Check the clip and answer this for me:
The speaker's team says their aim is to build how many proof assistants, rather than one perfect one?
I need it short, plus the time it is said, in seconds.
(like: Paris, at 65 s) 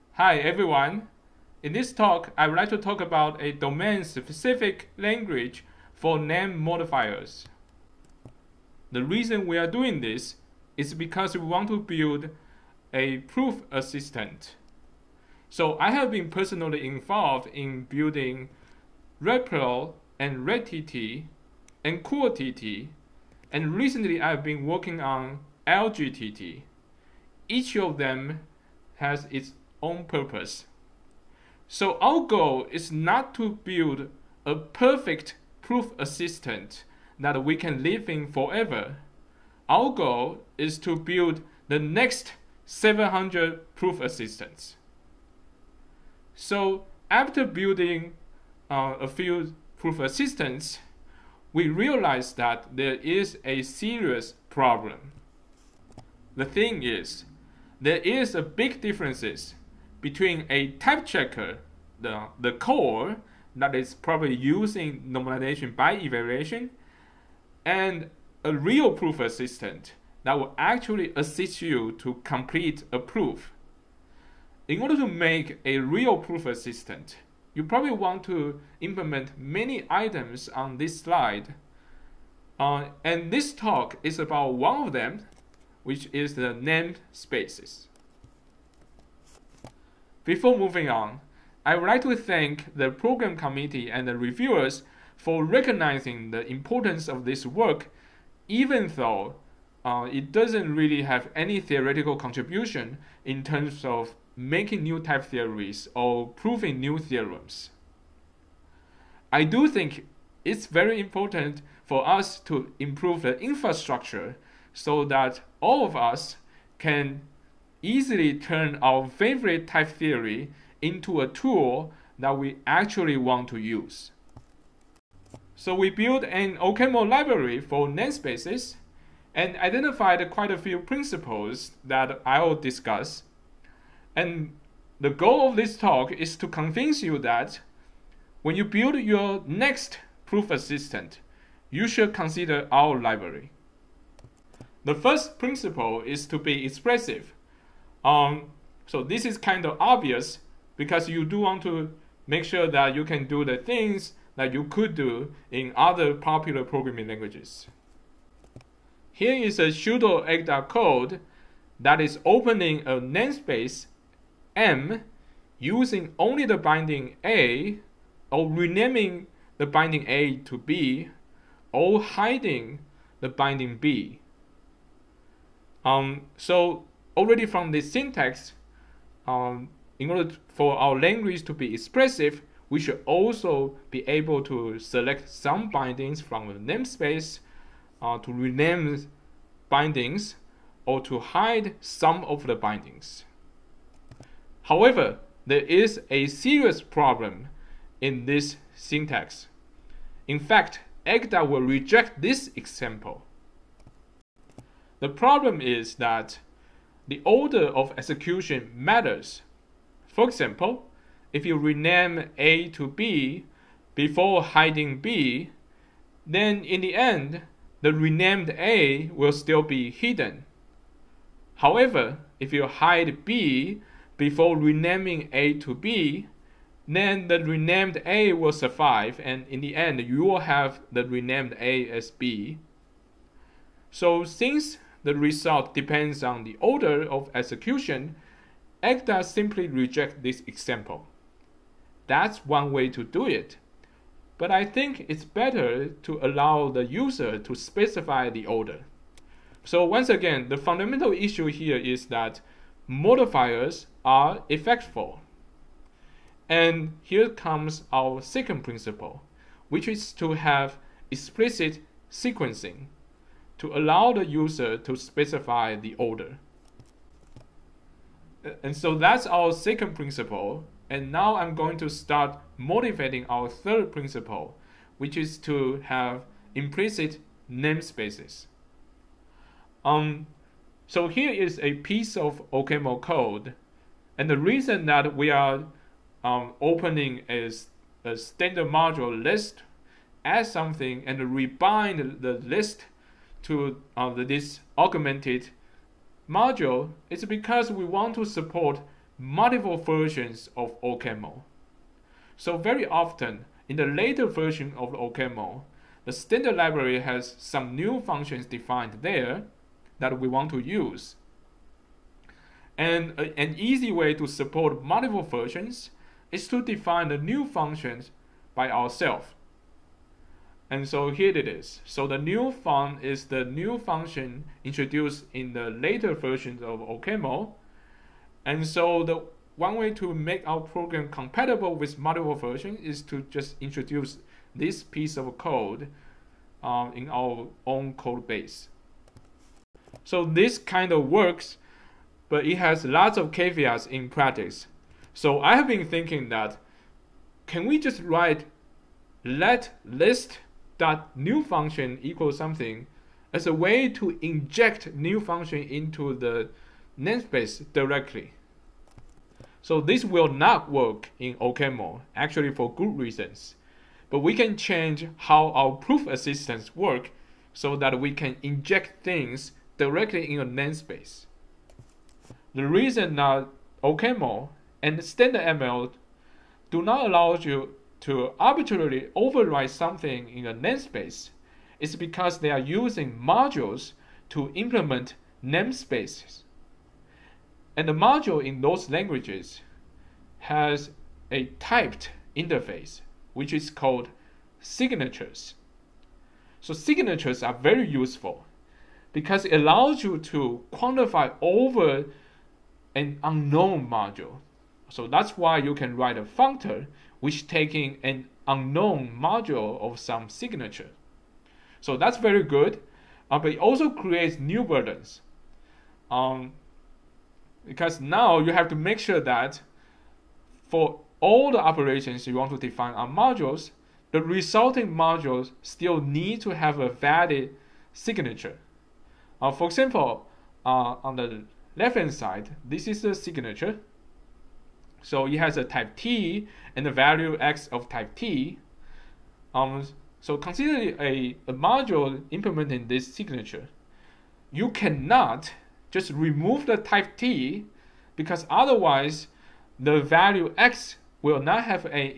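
700, at 42 s.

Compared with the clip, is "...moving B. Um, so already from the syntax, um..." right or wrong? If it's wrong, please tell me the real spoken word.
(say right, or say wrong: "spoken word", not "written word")
wrong: "binding", not "moving".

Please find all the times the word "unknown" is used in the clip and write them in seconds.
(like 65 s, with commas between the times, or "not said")
403 s, 408 s.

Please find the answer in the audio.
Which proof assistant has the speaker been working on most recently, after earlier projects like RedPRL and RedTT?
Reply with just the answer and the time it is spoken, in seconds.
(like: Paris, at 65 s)
algaett, at 25 s.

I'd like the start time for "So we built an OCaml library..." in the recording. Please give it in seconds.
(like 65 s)
125 s.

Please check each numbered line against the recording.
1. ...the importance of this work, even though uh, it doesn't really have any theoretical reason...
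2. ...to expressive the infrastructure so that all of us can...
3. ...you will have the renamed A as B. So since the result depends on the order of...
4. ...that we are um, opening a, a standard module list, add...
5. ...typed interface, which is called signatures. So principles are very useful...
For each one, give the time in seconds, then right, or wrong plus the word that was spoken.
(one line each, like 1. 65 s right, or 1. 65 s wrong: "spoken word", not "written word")
1. 96 s wrong: "contribution", not "reason"
2. 112 s wrong: "improve", not "expressive"
3. 229 s right
4. 284 s right
5. 391 s wrong: "signatures", not "principles".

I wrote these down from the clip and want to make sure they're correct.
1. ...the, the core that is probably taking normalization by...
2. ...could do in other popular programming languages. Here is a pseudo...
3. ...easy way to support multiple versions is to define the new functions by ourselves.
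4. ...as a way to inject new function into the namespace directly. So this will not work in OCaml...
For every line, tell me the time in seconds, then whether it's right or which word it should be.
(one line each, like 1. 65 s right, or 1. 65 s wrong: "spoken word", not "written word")
1. 61 s wrong: "using", not "taking"
2. 154 s right
3. 313 s right
4. 353 s right.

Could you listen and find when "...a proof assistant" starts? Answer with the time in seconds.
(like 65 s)
12 s.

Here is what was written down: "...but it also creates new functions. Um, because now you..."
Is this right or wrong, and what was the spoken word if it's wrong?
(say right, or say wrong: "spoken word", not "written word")
wrong: "burdens", not "functions".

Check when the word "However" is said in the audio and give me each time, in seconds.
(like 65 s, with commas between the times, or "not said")
194 s, 221 s.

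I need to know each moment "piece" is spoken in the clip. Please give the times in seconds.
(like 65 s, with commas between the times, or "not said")
281 s, 334 s.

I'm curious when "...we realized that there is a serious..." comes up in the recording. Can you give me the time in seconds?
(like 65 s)
51 s.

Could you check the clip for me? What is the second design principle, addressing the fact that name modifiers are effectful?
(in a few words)
explicit sequencing.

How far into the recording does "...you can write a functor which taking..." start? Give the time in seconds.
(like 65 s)
405 s.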